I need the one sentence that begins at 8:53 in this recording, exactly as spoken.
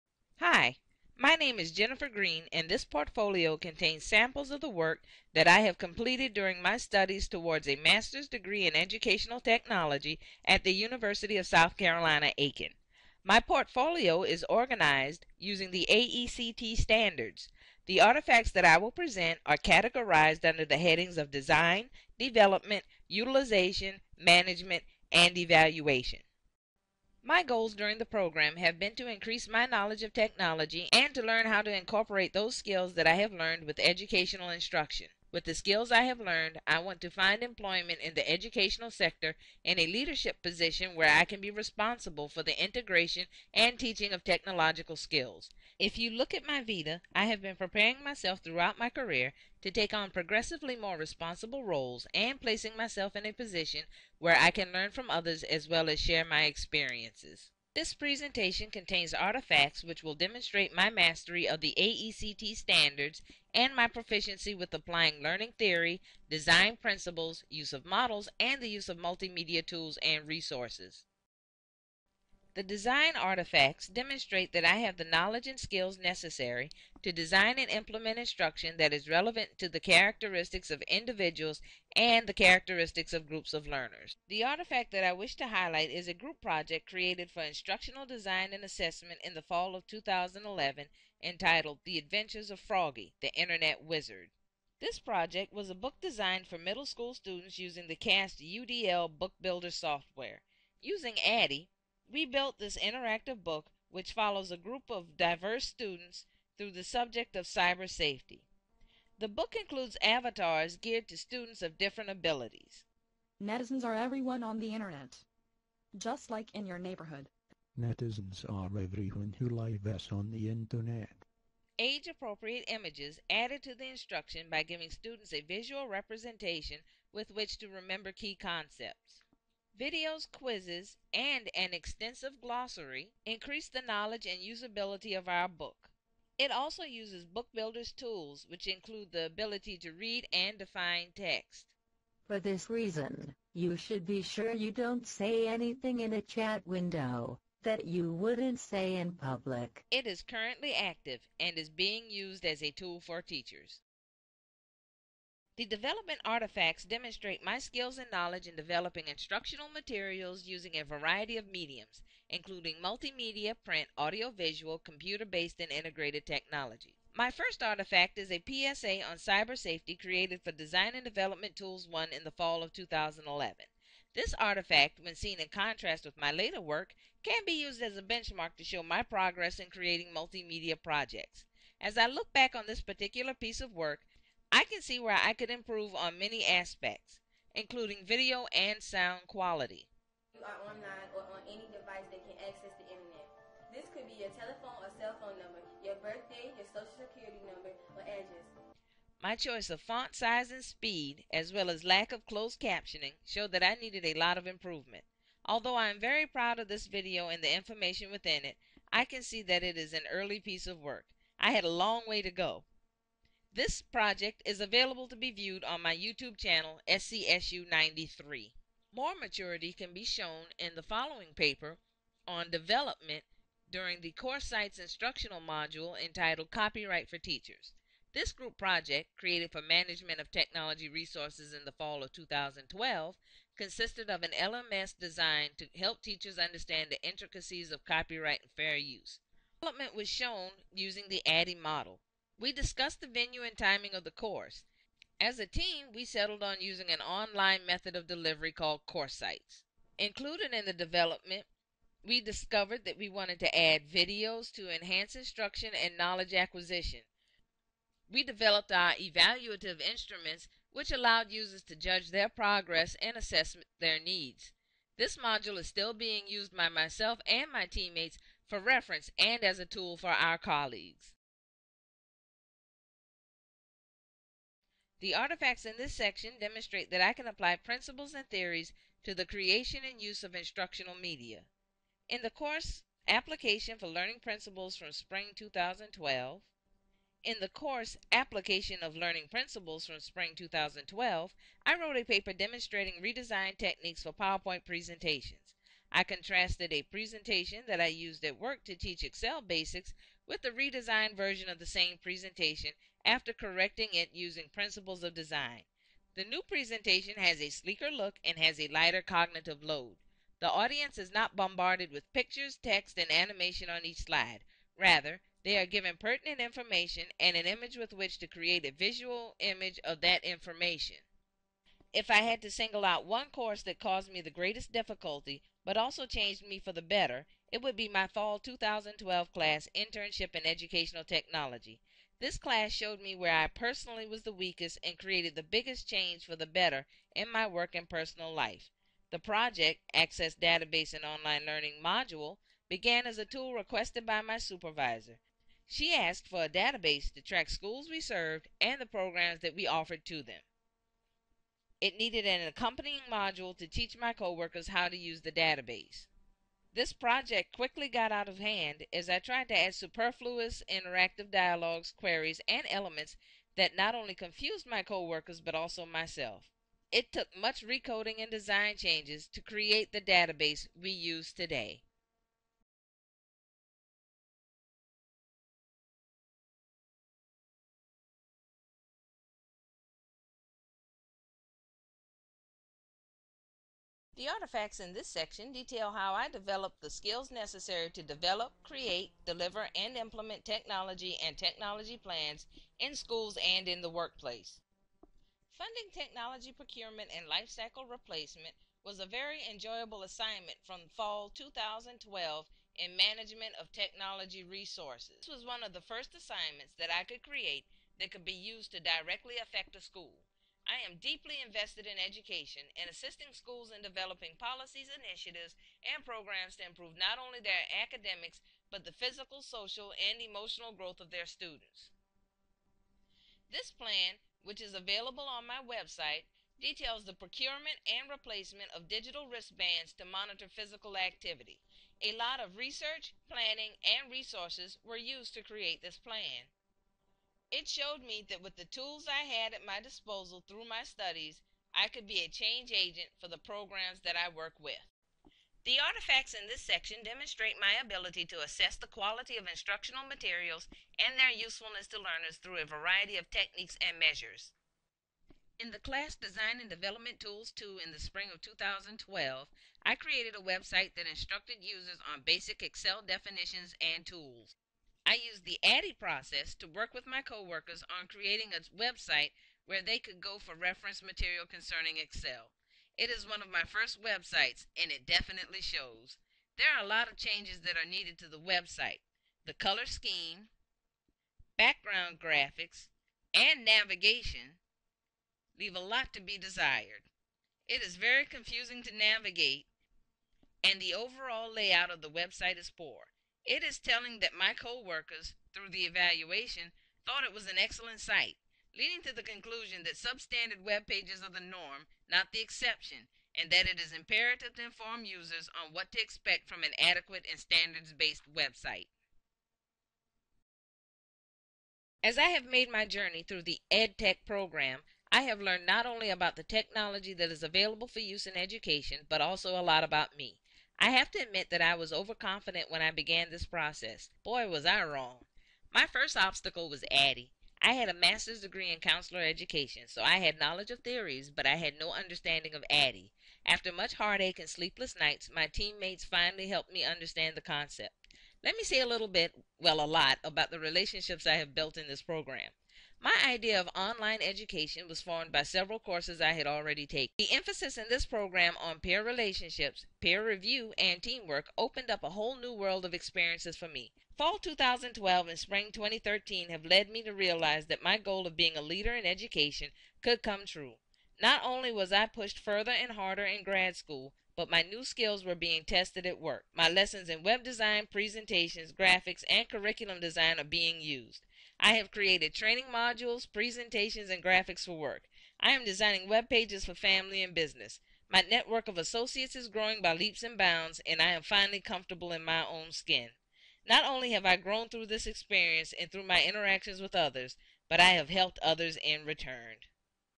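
After much heartache and sleepless nights, my teammates finally helped me understand the concept.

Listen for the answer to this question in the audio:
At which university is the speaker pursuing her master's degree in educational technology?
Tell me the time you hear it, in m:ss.
0:10.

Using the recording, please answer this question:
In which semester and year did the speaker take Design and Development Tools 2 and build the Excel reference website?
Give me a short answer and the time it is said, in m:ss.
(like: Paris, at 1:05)
spring 2012, at 7:37.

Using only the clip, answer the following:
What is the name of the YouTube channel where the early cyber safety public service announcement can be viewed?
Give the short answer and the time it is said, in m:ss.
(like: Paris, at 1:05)
SCSU93, at 3:36.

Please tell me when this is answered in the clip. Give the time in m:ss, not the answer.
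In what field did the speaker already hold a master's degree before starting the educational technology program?
8:48.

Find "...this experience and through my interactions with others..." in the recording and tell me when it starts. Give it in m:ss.
9:44.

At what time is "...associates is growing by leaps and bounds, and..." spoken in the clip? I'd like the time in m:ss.
9:38.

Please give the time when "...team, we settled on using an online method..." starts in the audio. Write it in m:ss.
4:05.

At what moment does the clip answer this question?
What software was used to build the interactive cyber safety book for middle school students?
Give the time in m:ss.
1:37.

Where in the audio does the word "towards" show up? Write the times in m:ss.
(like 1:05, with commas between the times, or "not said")
0:07.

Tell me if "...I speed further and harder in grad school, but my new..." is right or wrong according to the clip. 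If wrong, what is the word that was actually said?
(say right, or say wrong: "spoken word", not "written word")
wrong: "pushed", not "speed".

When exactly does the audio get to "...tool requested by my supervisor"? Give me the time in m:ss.
5:43.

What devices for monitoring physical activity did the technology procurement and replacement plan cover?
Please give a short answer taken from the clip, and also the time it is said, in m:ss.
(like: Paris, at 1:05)
digital wristbands, at 7:08.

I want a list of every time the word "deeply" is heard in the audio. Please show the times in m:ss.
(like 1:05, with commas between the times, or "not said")
6:50.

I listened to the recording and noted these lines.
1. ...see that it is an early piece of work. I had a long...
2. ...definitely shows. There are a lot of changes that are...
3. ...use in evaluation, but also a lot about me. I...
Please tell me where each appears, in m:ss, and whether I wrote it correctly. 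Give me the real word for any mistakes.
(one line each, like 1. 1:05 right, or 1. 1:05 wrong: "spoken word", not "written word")
1. 3:29 right
2. 7:55 right
3. 8:38 wrong: "education", not "evaluation".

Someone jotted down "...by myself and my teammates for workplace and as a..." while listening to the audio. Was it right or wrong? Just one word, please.
wrong.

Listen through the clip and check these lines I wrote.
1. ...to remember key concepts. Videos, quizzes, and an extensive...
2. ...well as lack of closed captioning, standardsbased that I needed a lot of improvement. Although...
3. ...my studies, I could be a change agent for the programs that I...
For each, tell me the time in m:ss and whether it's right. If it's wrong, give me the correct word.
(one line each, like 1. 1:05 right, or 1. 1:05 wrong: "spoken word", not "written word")
1. 2:07 right
2. 3:21 wrong: "showed", not "standardsbased"
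3. 7:20 right.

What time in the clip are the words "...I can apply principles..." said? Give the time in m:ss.
4:37.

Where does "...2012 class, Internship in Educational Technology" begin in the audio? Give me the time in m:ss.
5:28.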